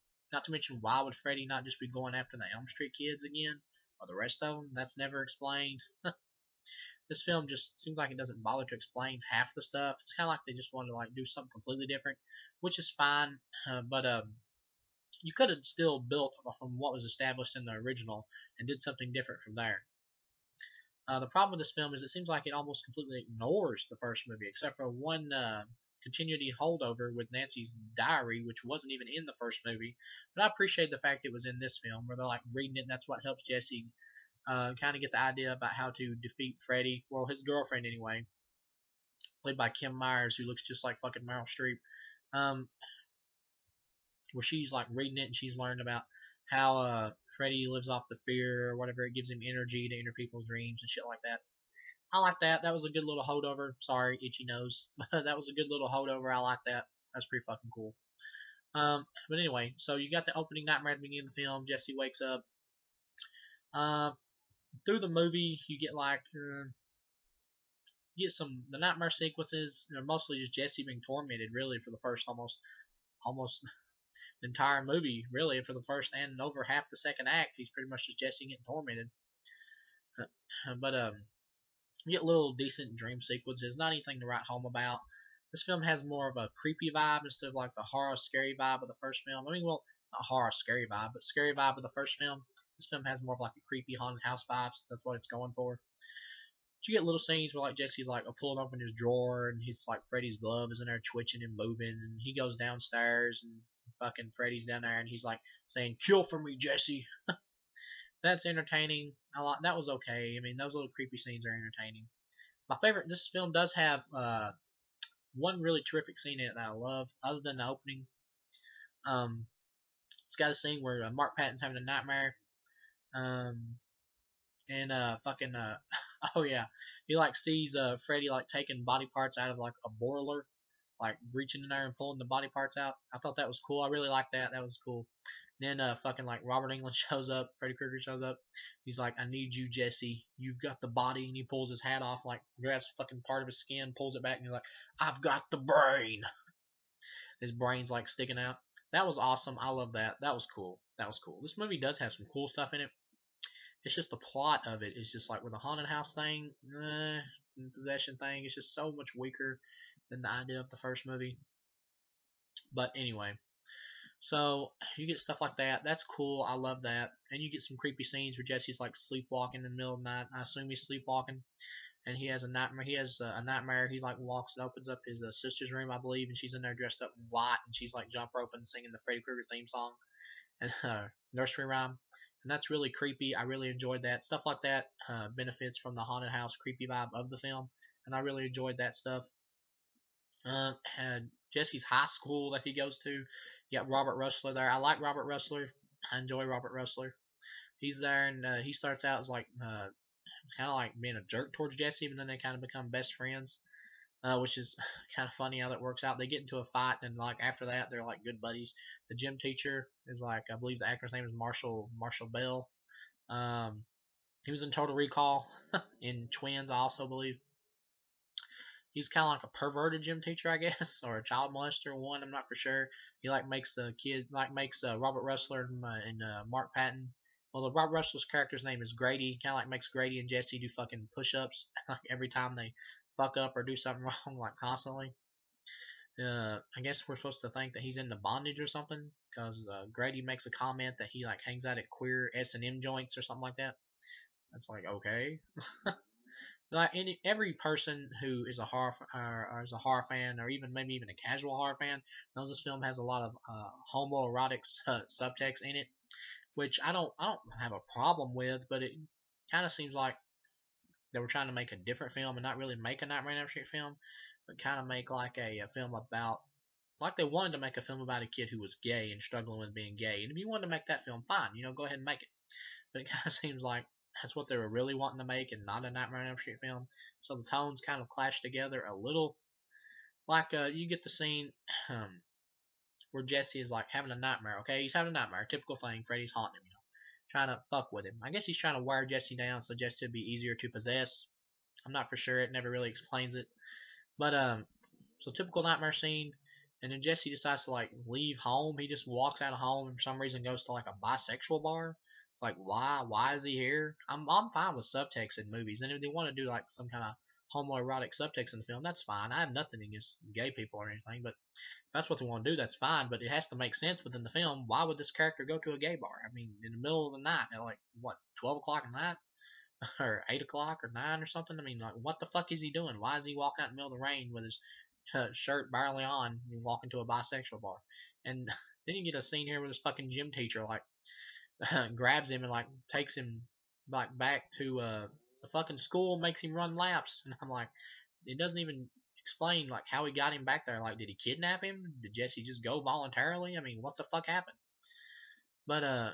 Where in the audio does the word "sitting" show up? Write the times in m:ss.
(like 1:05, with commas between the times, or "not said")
not said.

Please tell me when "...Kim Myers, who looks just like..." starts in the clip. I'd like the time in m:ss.
0:39.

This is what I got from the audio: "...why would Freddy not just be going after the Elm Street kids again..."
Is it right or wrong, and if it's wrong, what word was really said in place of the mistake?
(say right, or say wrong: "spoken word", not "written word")
right.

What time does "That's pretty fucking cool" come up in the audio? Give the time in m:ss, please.
0:57.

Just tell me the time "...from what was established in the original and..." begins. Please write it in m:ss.
0:16.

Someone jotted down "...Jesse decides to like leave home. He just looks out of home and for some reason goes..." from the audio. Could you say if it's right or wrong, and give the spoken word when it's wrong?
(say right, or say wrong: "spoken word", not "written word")
wrong: "walks", not "looks".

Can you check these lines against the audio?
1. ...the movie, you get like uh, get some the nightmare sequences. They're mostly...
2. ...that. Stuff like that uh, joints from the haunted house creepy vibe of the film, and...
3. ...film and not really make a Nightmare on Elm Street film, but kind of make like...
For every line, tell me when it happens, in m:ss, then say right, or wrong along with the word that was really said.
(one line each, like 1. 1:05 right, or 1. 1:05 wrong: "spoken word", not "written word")
1. 1:04 right
2. 3:04 wrong: "benefits", not "joints"
3. 4:22 right.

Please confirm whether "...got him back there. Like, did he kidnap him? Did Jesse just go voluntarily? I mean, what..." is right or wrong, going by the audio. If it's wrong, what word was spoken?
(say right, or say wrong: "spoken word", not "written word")
right.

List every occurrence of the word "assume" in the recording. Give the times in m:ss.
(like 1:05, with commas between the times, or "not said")
2:50.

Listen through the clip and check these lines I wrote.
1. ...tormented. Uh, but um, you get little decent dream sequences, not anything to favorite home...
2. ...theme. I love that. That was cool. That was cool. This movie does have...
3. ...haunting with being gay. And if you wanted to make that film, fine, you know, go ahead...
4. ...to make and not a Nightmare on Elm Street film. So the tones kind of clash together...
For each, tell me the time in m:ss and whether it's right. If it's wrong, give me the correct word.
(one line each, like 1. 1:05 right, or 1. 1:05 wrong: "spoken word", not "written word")
1. 1:18 wrong: "write", not "favorite"
2. 2:29 wrong: "awesome", not "theme"
3. 4:29 wrong: "struggling", not "haunting"
4. 4:35 right.